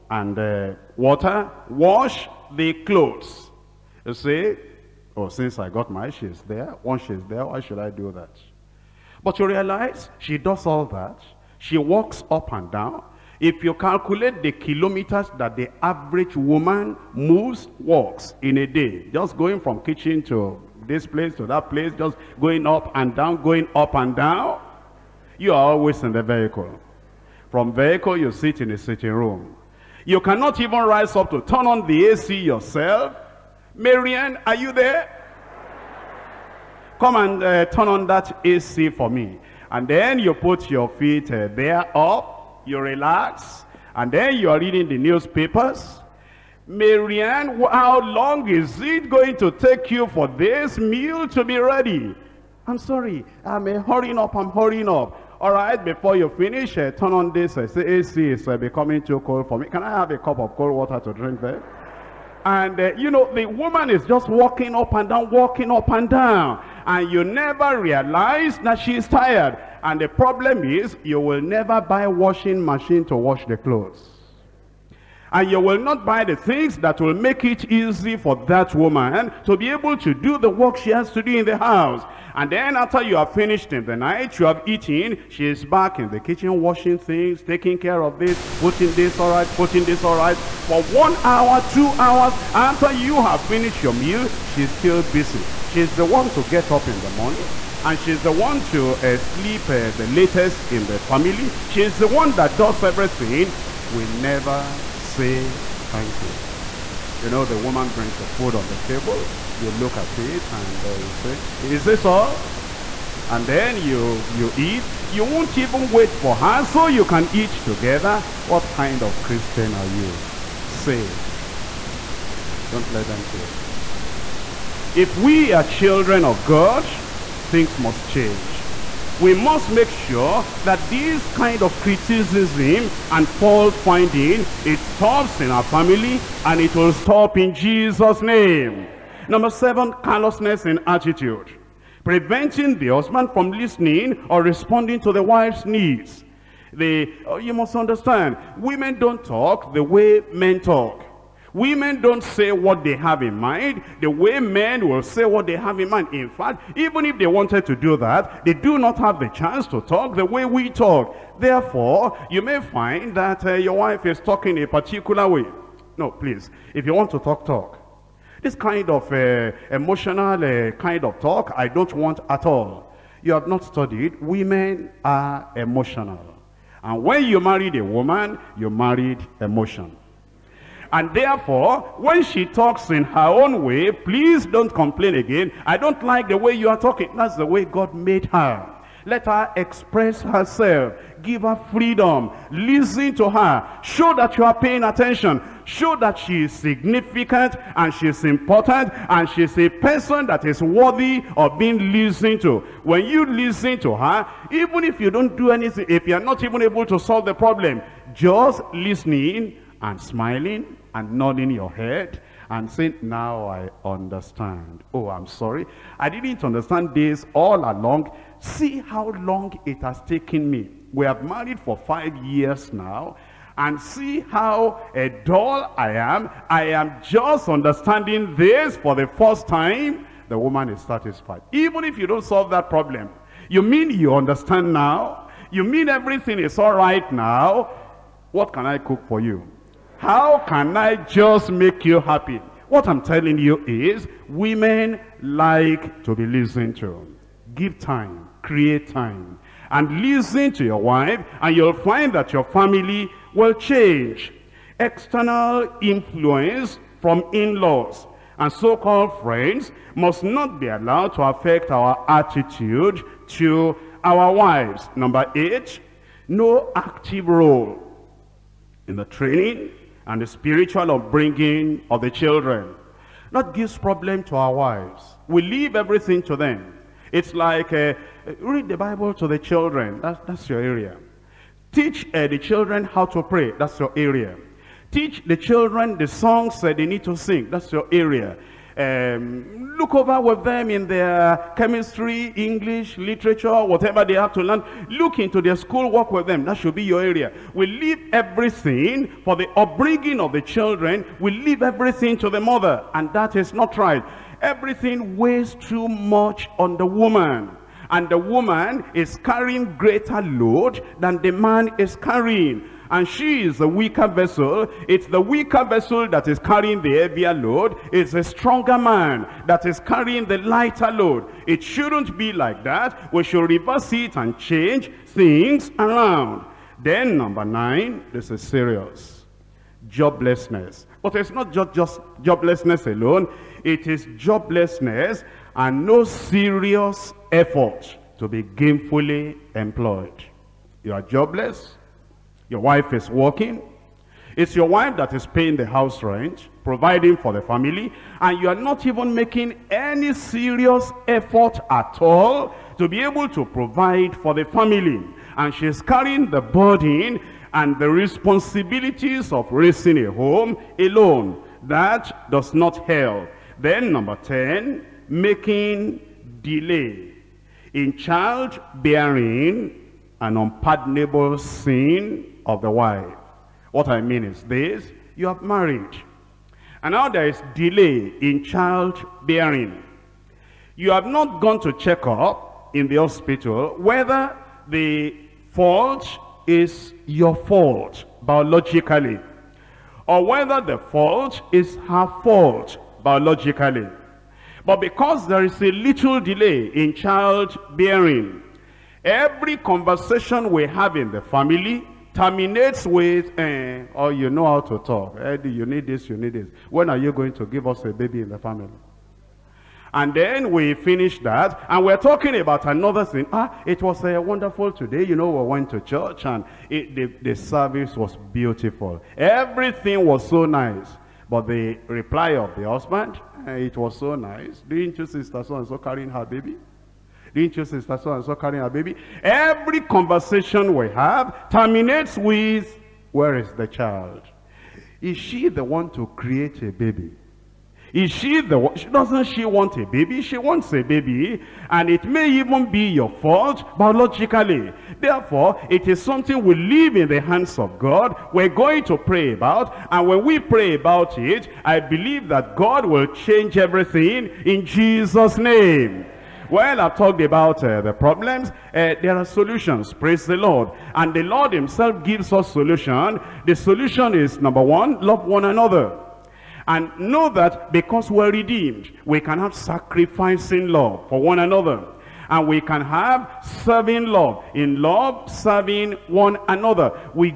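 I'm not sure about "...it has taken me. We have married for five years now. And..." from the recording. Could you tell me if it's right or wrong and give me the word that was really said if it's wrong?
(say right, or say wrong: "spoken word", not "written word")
right.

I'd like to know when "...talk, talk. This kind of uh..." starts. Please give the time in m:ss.
2:47.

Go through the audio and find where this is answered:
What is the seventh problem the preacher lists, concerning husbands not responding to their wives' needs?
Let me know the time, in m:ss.
2:20.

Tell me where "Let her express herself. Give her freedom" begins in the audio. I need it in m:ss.
3:09.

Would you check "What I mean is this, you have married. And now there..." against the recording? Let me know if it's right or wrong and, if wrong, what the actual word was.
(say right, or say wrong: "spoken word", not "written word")
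right.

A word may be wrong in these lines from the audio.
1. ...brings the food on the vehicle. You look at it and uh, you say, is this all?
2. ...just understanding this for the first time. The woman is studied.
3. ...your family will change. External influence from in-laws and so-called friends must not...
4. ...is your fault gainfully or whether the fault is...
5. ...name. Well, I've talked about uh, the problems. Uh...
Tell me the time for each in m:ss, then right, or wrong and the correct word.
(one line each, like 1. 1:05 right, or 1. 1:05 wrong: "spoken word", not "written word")
1. 1:47 wrong: "table", not "vehicle"
2. 3:47 wrong: "satisfied", not "studied"
3. 4:12 right
4. 6:26 wrong: "biologically", not "gainfully"
5. 7:35 right.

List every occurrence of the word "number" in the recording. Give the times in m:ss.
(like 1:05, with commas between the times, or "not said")
2:19, 4:24, 5:27, 6:03, 7:44.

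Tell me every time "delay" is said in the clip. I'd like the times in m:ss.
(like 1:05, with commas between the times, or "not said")
6:06, 6:17, 6:36.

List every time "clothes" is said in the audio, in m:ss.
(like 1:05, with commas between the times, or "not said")
0:02, 1:13.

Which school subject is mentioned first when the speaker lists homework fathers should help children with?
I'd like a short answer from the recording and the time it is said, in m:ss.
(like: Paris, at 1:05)
Chemistry, at 4:51.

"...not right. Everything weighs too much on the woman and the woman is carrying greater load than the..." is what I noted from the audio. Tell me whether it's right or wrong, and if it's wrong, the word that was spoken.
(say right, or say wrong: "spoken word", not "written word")
right.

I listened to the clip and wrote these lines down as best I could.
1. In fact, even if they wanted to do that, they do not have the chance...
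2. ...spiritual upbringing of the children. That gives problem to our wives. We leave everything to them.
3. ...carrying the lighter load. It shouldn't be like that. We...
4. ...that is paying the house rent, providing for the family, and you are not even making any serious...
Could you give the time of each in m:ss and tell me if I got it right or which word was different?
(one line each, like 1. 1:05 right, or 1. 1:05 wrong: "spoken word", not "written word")
1. 2:36 right
2. 4:30 right
3. 5:19 right
4. 5:44 right.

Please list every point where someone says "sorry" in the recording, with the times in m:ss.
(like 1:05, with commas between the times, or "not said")
0:52, 3:35.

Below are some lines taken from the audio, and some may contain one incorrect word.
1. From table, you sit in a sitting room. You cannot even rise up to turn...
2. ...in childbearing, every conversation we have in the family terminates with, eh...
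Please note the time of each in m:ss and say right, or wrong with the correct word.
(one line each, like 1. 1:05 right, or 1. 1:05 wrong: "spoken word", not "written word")
1. 0:27 wrong: "vehicle", not "table"
2. 6:36 right.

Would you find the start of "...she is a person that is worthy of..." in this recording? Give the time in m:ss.
3:19.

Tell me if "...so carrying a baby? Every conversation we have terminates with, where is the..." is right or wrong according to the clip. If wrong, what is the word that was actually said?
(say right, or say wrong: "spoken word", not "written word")
right.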